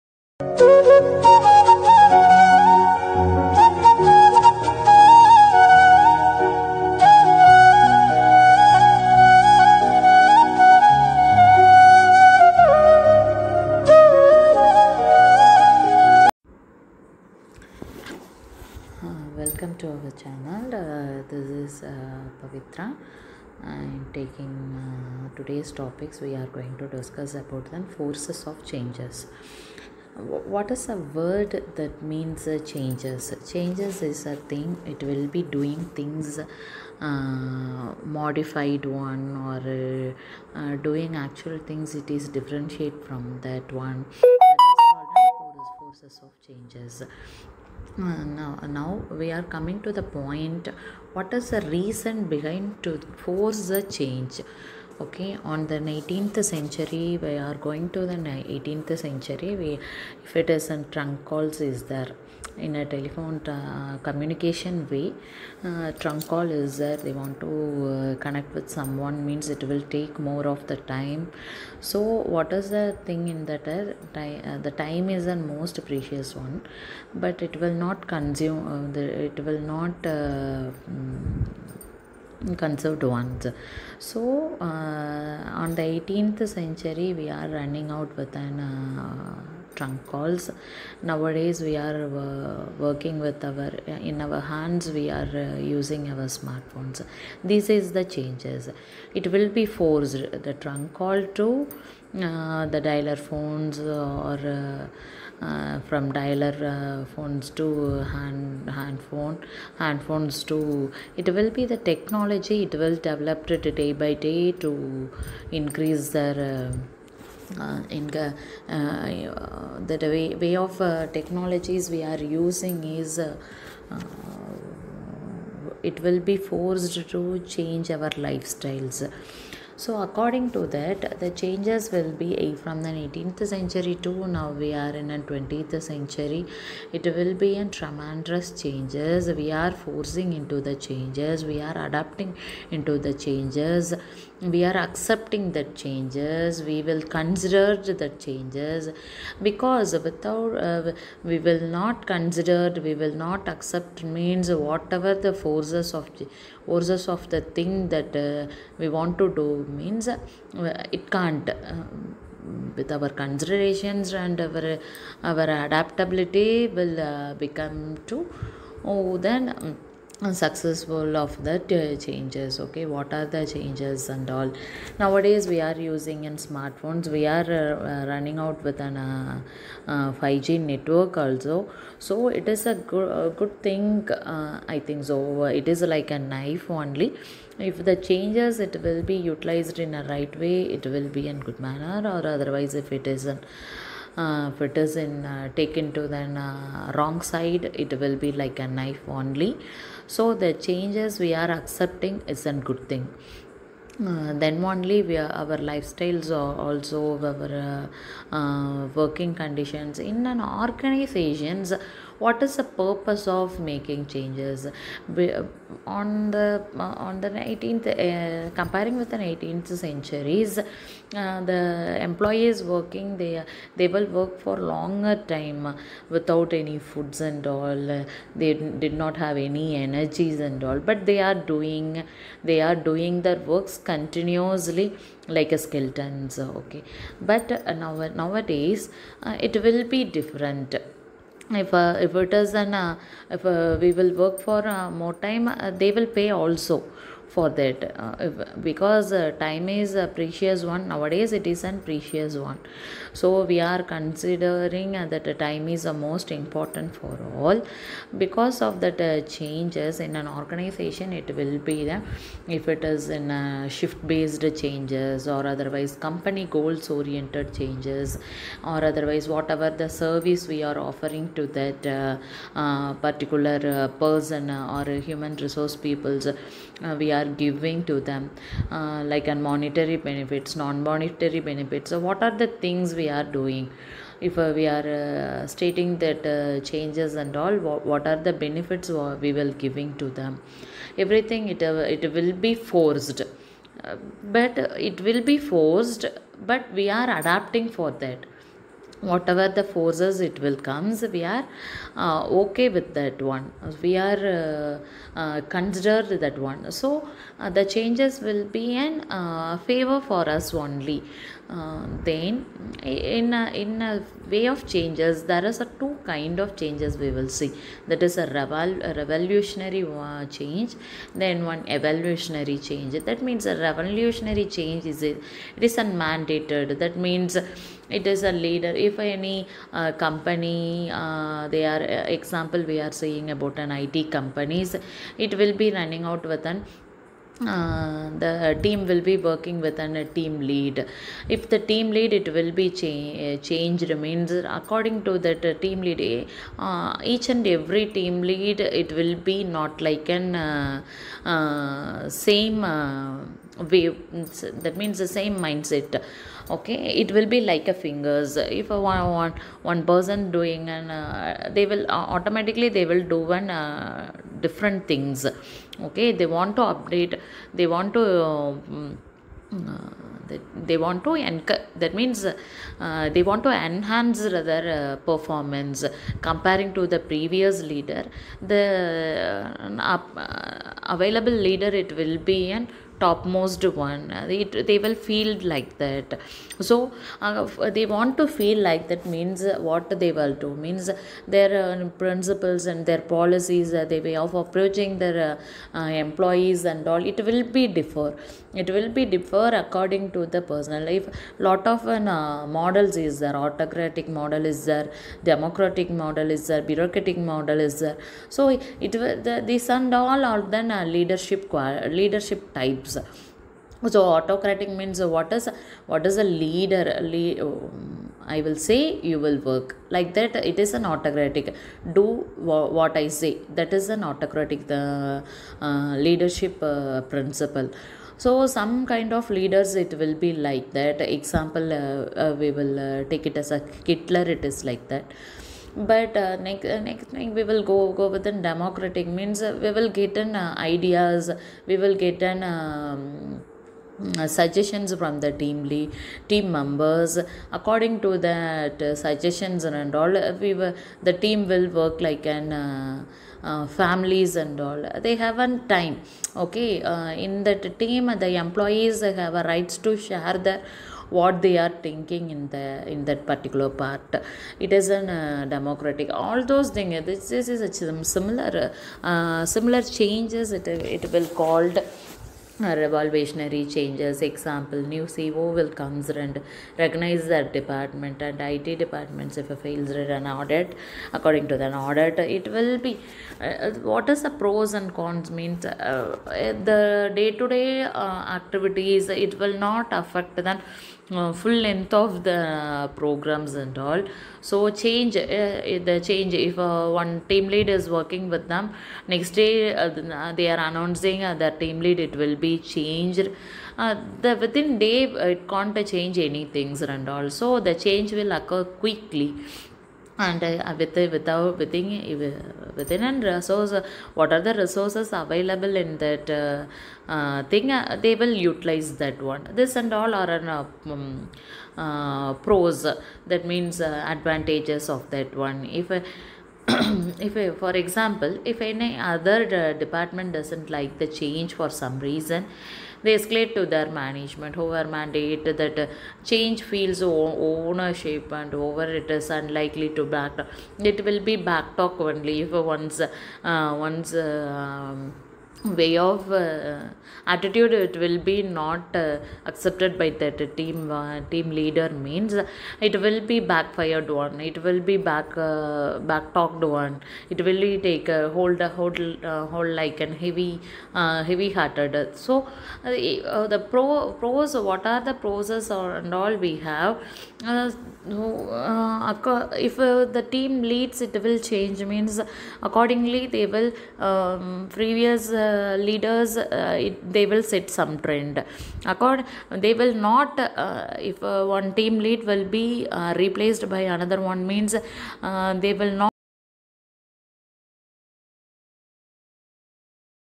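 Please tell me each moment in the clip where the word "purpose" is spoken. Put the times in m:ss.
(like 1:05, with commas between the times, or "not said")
3:32.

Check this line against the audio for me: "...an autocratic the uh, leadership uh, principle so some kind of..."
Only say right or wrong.
right.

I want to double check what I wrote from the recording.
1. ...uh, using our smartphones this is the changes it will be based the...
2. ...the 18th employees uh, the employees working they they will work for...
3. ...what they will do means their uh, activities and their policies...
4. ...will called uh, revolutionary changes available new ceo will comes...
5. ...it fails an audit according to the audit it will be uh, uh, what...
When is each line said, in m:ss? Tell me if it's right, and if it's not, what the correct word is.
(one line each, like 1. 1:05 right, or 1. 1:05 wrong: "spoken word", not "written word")
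1. 1:35 wrong: "forced", not "based"
2. 3:39 wrong: "centuries", not "employees"
3. 6:29 wrong: "principles", not "activities"
4. 7:51 wrong: "example", not "available"
5. 7:59 right.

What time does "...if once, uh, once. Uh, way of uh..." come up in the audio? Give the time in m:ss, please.
9:02.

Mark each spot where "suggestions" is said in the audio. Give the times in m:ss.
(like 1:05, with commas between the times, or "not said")
7:24, 7:28.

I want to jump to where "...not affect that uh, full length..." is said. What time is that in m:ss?
8:09.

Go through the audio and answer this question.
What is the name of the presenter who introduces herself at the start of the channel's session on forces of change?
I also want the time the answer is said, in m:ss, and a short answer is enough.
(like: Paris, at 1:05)
Pavithra, at 0:22.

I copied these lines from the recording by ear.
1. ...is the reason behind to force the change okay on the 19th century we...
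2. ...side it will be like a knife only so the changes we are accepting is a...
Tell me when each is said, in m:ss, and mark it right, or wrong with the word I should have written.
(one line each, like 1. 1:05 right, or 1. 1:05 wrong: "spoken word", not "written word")
1. 0:51 right
2. 3:17 right.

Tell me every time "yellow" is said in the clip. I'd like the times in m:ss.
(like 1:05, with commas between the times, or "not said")
not said.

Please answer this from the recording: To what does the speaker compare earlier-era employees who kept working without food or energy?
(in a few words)
skeletons.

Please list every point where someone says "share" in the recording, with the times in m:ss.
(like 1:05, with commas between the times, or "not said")
7:39.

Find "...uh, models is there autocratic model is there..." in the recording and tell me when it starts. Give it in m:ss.
6:41.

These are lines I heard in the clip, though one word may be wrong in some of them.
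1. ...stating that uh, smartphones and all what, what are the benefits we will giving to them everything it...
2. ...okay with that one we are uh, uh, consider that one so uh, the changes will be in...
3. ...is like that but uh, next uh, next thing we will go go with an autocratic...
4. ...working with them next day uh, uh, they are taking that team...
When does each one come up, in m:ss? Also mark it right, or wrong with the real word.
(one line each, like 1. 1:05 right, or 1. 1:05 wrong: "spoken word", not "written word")
1. 4:45 wrong: "changes", not "smartphones"
2. 5:02 right
3. 7:14 wrong: "democratic", not "autocratic"
4. 8:17 wrong: "announcing", not "taking".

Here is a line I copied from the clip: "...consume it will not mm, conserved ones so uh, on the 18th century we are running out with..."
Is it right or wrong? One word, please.
right.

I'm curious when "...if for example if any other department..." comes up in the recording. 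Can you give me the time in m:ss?
8:46.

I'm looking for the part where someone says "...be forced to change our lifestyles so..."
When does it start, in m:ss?
2:06.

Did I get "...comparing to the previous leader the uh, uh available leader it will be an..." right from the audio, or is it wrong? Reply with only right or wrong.
right.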